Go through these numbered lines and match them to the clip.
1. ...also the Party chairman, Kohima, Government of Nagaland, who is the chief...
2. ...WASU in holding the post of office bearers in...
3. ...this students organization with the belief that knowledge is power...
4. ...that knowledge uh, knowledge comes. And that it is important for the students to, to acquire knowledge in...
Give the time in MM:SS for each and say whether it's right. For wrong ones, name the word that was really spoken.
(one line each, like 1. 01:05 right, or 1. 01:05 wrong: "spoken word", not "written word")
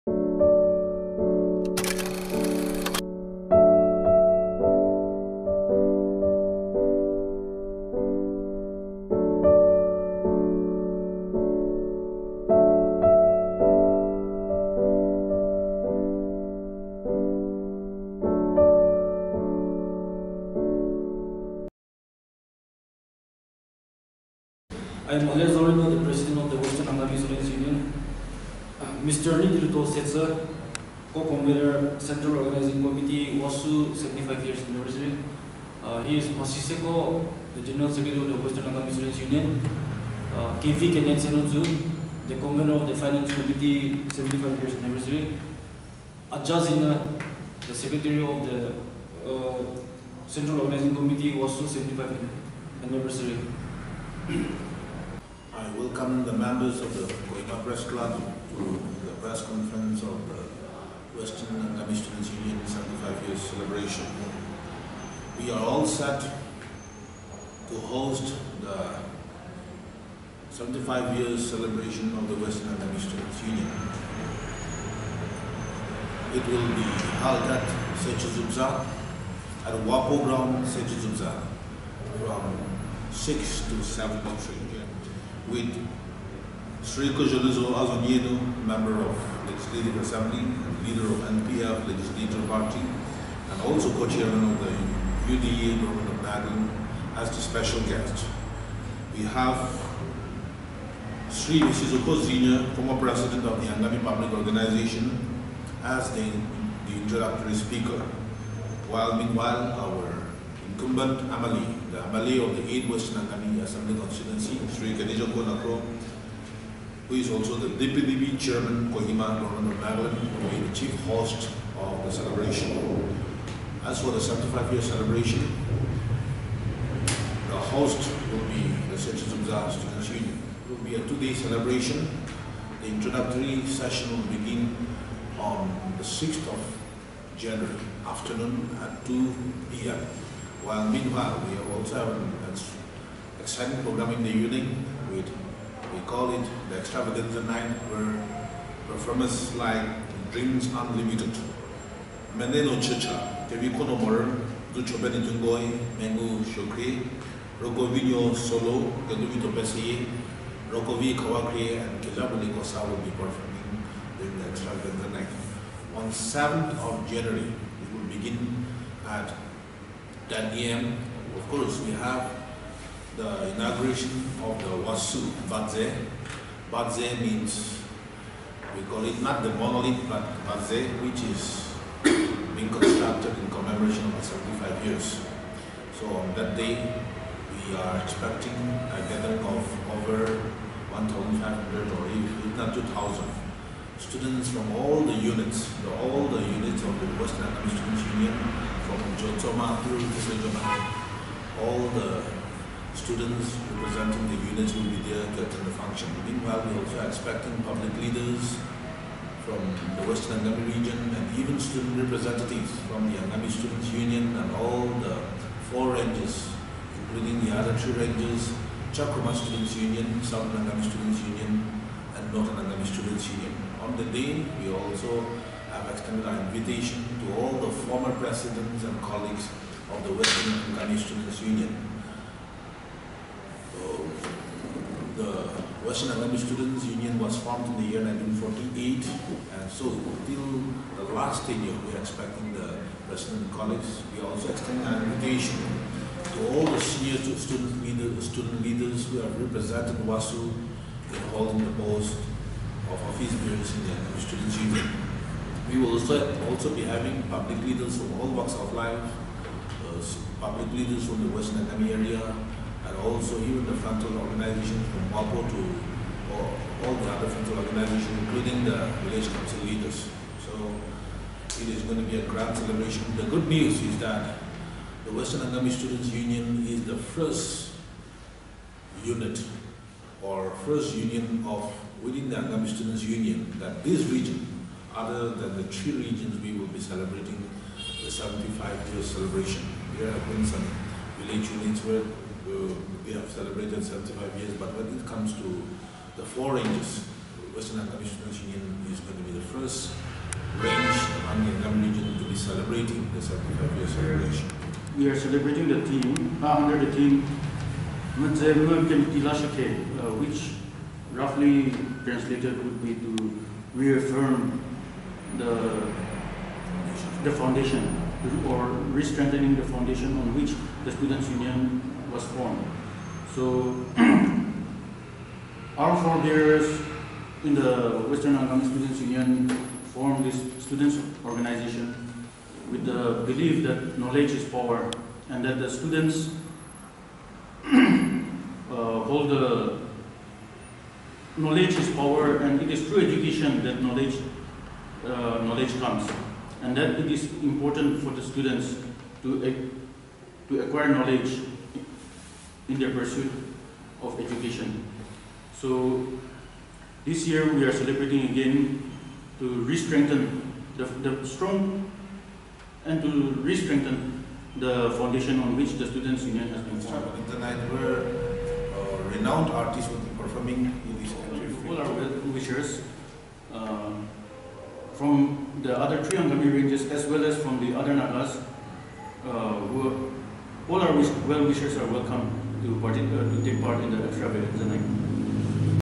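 1. 01:57 wrong: "DPDB", not "Party"
2. 04:10 right
3. 05:30 right
4. 05:43 right.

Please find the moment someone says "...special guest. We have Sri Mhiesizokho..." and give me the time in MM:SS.
01:37.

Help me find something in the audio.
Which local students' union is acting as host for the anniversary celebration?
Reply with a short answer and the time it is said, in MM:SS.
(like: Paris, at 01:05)
Sechü Zubza Students Union, at 02:08.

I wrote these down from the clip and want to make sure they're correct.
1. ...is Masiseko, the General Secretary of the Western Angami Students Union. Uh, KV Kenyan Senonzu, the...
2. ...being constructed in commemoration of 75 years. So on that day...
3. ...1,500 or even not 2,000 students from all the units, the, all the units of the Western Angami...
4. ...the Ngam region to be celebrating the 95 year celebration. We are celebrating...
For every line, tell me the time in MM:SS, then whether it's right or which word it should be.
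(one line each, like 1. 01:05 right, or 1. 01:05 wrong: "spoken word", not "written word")
1. 00:36 right
2. 03:02 right
3. 03:10 right
4. 05:01 wrong: "75", not "95".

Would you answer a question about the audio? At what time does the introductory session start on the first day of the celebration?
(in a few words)
2 p.m.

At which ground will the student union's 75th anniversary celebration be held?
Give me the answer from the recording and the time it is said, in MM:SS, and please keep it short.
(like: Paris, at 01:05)
Wapo Ground, at 01:19.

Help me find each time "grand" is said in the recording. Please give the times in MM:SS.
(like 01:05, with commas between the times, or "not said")
04:32.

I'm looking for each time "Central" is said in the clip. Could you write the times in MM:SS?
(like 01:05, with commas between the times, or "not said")
00:31, 00:50.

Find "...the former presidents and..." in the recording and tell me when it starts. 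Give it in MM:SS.
03:47.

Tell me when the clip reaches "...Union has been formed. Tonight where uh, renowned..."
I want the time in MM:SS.
06:06.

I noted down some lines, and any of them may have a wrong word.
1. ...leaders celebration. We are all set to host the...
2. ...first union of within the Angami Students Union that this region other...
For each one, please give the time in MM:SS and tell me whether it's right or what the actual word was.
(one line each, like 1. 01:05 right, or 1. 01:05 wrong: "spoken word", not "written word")
1. 01:03 wrong: "years", not "leaders"
2. 04:40 right.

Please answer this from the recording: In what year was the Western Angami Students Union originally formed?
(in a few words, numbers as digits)
1948.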